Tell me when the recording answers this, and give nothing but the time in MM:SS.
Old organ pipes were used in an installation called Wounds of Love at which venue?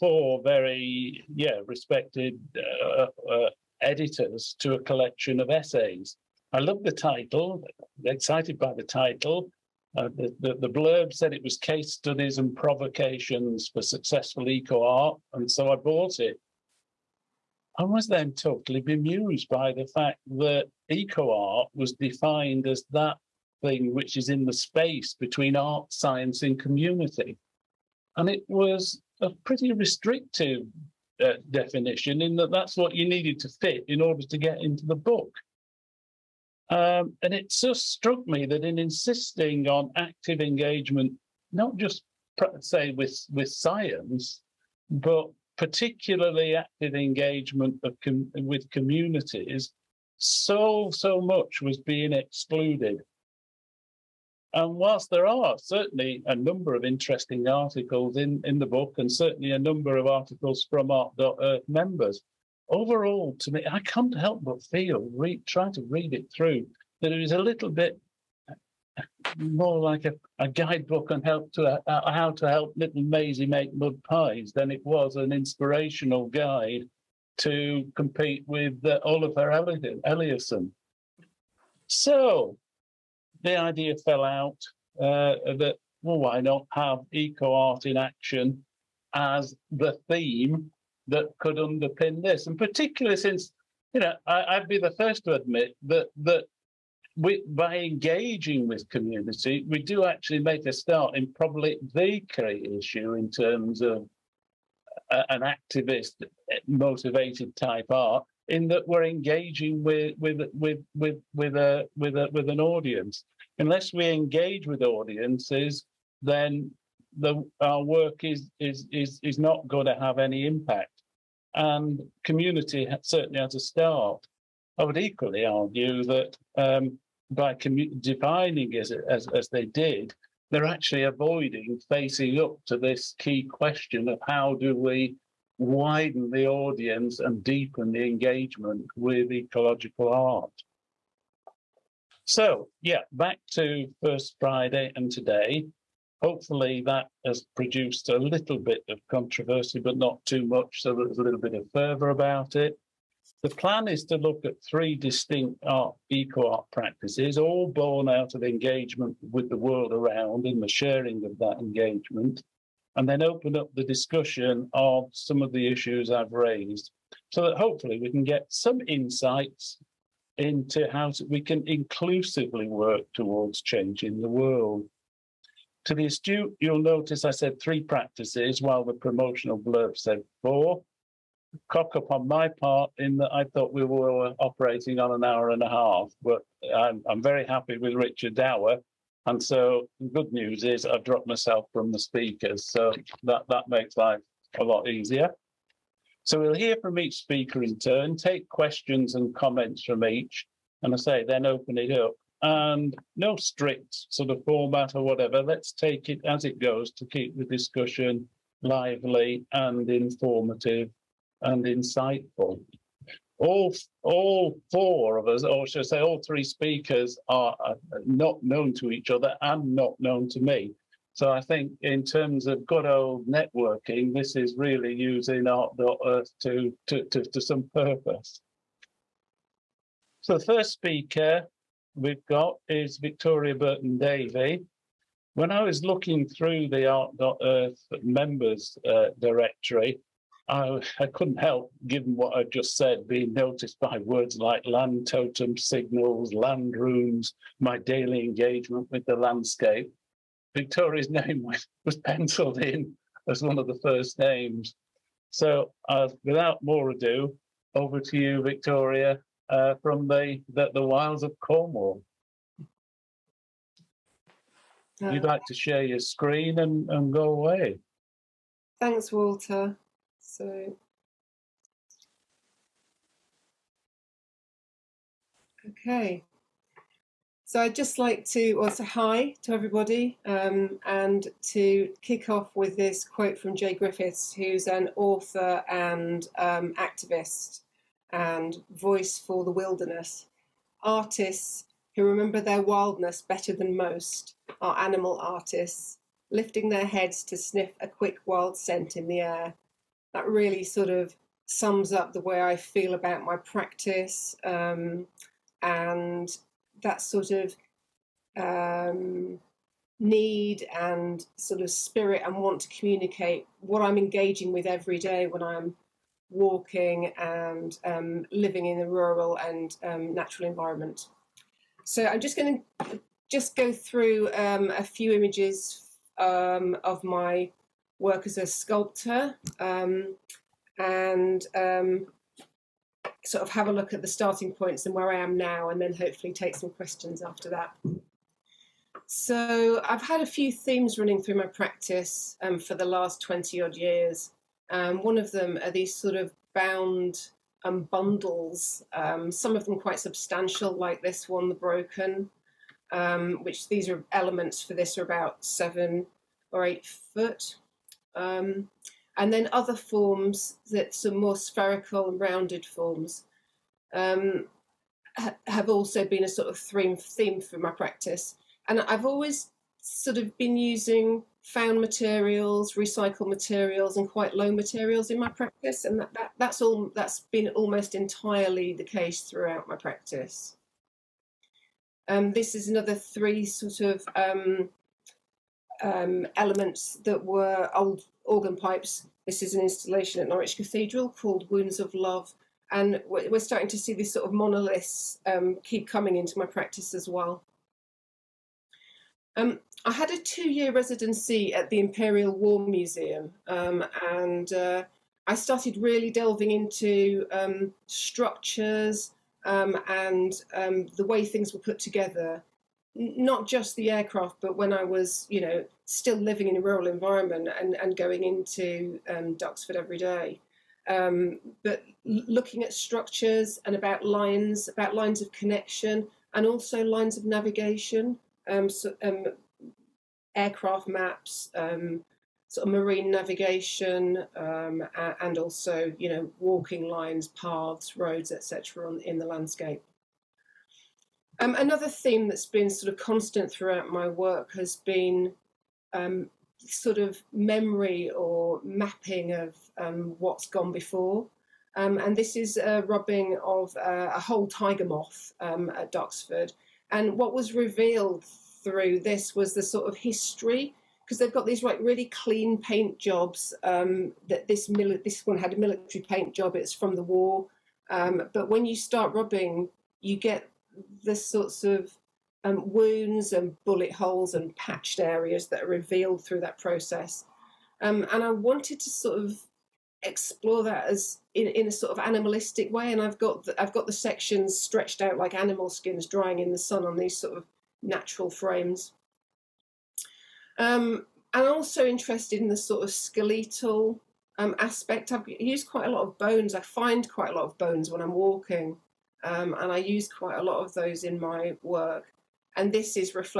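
06:30.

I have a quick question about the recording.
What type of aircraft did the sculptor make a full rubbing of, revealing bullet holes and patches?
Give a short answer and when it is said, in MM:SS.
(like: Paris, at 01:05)
tiger moth, at 07:34.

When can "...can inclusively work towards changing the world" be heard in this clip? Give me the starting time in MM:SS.
02:51.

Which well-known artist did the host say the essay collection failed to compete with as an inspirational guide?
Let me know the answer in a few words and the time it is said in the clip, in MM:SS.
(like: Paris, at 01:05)
Olafur Eliasson, at 01:19.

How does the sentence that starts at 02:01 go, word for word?
And community certainly has a start.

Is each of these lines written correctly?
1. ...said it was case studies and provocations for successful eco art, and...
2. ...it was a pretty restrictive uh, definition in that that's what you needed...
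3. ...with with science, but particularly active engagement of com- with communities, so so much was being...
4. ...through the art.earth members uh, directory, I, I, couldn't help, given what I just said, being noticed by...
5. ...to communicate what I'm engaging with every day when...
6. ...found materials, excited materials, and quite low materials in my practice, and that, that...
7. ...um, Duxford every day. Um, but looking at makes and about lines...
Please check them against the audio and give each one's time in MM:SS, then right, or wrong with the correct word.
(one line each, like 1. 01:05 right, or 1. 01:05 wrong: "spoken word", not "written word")
1. 00:11 right
2. 00:28 right
3. 00:42 right
4. 03:56 right
5. 05:12 right
6. 06:11 wrong: "recycled", not "excited"
7. 06:59 wrong: "structures", not "makes".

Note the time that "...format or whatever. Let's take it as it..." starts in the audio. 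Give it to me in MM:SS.
03:24.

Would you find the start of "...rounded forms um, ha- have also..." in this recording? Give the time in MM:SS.
06:02.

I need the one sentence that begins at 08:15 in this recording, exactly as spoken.
I have used quite a lot of bones.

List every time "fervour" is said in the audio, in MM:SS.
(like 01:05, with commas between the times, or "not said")
02:31.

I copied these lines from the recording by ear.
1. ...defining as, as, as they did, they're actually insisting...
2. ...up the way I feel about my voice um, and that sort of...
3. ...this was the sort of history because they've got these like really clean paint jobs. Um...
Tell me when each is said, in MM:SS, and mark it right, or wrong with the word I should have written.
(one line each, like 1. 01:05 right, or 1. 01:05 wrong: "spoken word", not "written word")
1. 02:08 wrong: "avoiding", not "insisting"
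2. 05:01 wrong: "practice", not "voice"
3. 07:38 right.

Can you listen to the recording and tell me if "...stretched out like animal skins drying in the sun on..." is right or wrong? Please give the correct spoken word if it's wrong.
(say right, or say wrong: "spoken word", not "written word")
right.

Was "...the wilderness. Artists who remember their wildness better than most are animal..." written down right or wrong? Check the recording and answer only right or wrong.
right.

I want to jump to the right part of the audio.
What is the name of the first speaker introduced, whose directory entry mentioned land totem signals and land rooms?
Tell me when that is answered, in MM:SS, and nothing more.
03:52.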